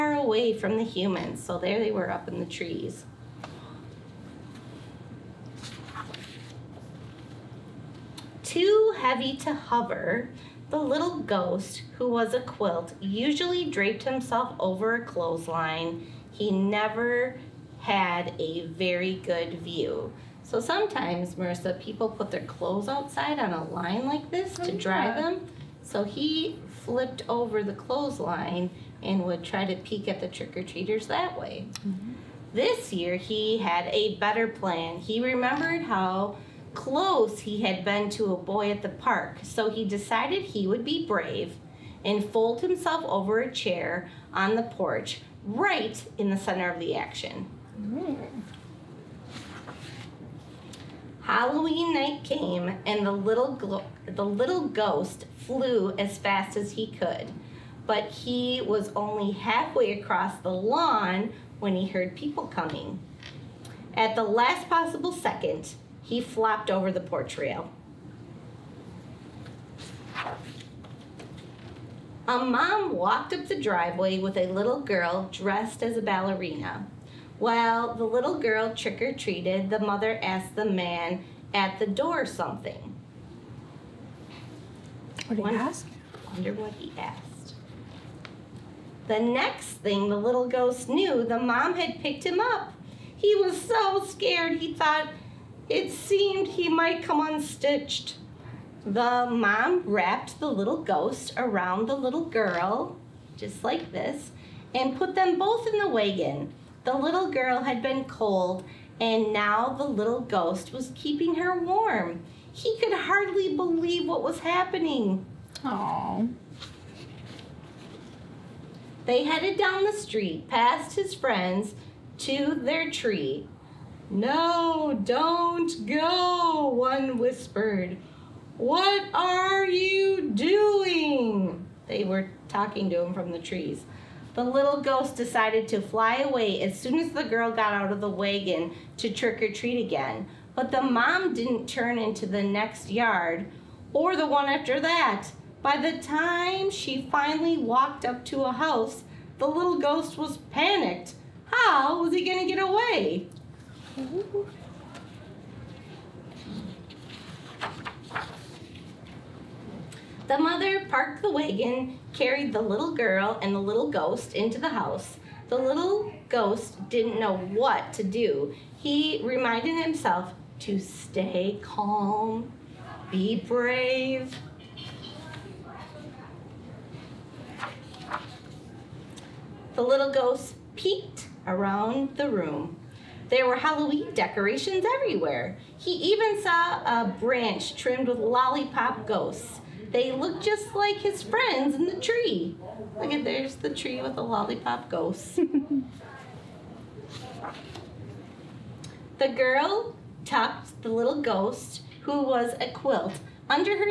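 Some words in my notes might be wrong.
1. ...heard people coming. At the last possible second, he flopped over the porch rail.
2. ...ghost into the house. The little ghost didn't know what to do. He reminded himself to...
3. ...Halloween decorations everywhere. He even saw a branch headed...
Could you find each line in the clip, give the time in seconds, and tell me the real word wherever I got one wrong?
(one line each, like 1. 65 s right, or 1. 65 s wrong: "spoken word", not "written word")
1. 61 s right
2. 163 s right
3. 183 s wrong: "trimmed", not "headed".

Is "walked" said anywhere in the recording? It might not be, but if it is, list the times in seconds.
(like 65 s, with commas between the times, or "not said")
72 s, 147 s.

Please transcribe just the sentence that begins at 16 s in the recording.
He never had a very good view.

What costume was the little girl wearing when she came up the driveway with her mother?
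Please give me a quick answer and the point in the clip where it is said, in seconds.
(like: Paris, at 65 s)
Ballerina, at 76 s.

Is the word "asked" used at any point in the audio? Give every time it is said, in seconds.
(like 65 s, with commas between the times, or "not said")
80 s, 86 s.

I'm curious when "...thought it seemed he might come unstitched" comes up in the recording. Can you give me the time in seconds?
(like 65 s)
94 s.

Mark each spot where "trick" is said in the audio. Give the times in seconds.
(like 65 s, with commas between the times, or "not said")
30 s, 78 s, 139 s.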